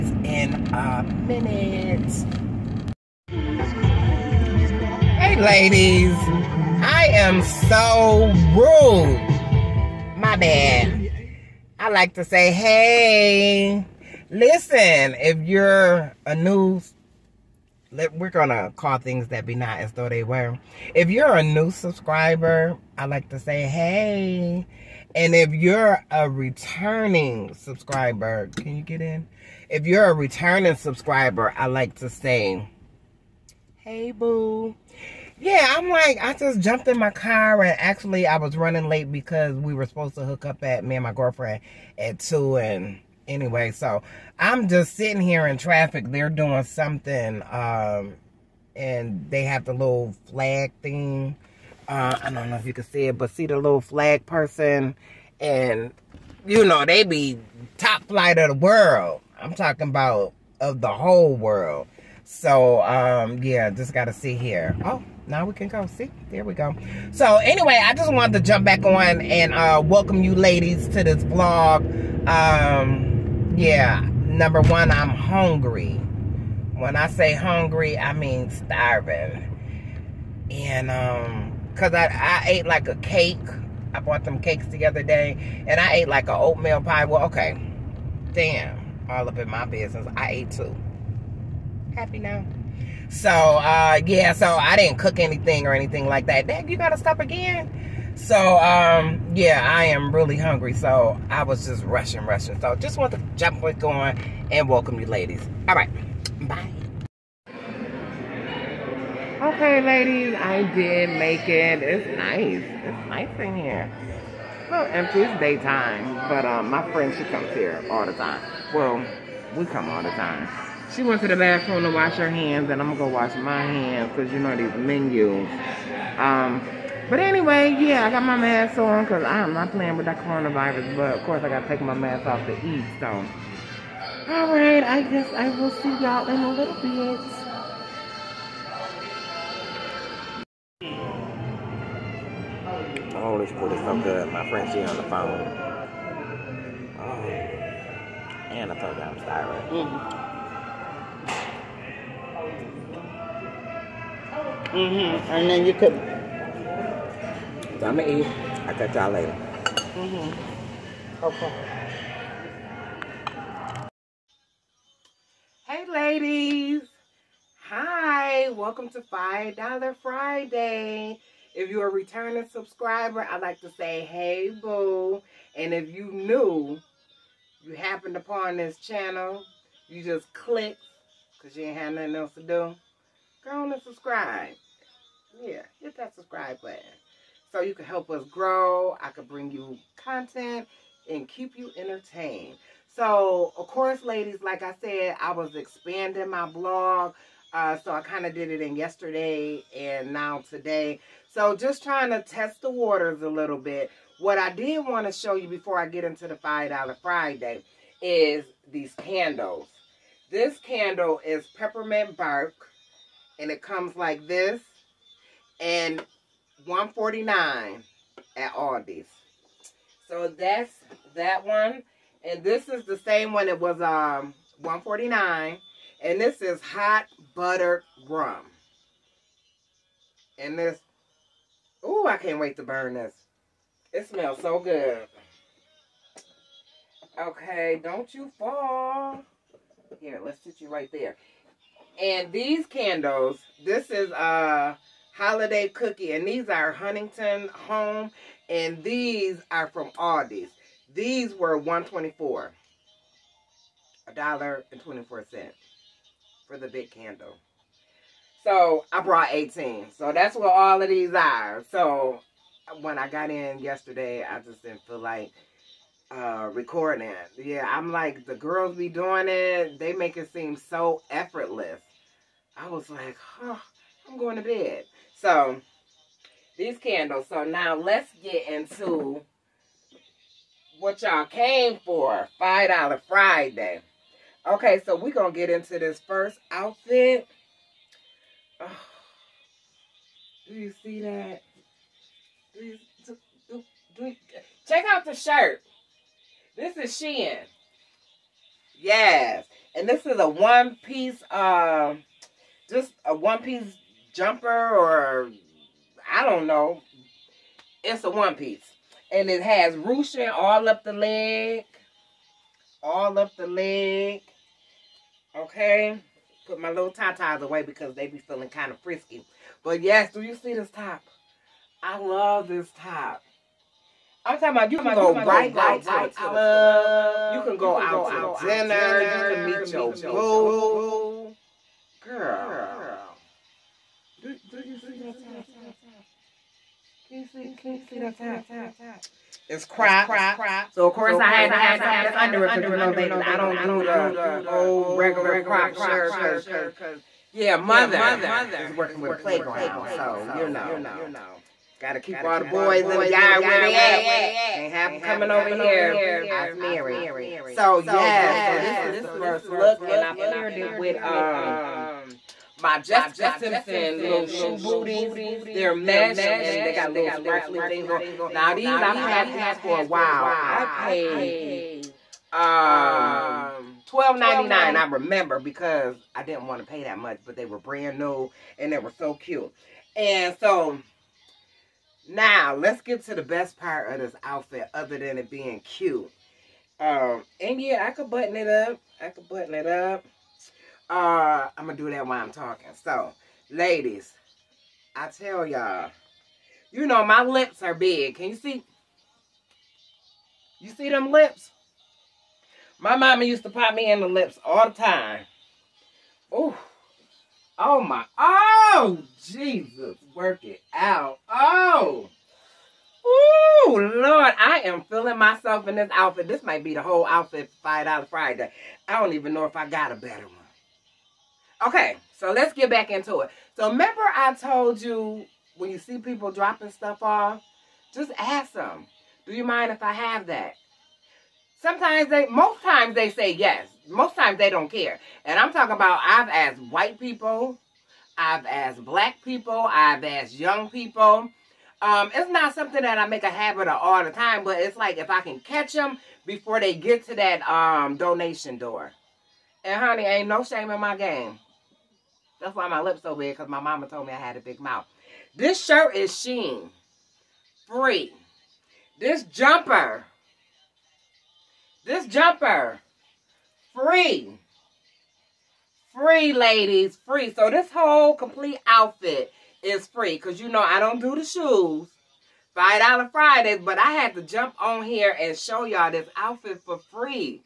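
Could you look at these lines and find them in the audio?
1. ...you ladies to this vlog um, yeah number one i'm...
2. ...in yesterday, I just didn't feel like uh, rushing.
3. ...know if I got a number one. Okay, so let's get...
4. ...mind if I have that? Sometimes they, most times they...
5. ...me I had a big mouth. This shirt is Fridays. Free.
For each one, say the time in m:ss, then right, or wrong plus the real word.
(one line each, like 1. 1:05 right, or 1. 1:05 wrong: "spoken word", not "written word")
1. 1:10 right
2. 4:23 wrong: "recording", not "rushing"
3. 6:59 wrong: "better", not "number"
4. 7:09 right
5. 7:34 wrong: "Shein", not "Fridays".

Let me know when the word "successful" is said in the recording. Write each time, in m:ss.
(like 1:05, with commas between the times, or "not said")
not said.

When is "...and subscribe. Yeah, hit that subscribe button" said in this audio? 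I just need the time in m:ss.
3:03.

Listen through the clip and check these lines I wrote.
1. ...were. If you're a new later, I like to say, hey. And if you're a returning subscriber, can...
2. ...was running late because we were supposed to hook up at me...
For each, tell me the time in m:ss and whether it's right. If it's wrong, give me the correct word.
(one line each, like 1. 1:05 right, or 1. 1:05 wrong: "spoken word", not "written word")
1. 0:20 wrong: "subscriber", not "later"
2. 0:38 right.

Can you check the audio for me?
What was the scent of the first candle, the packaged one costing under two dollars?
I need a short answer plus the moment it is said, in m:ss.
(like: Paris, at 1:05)
Peppermint bark, at 3:31.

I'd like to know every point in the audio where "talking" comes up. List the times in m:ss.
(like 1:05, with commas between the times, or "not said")
0:59, 5:24, 6:32, 7:15.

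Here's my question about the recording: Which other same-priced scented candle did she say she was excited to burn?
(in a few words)
Hot butter rum.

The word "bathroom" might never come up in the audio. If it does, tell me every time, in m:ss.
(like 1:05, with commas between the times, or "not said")
2:01.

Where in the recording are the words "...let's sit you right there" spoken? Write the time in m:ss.
4:00.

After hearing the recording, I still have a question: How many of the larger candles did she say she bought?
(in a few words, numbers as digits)
18.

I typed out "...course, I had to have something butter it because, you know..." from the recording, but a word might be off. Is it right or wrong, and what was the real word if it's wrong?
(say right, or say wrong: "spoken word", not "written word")
wrong: "under", not "butter".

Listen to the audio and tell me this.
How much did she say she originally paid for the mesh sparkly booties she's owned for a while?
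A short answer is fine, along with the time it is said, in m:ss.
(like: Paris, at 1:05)
$12.99, at 6:13.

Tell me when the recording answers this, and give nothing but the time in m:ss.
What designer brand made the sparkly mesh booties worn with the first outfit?
6:02.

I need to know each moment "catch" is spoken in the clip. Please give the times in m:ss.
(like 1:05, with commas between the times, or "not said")
2:38, 7:25.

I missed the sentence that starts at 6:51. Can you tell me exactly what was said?
Oh, oh, Lord, I am feeling myself in this outfit.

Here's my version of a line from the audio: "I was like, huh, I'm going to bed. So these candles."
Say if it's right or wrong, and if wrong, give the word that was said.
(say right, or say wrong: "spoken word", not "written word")
right.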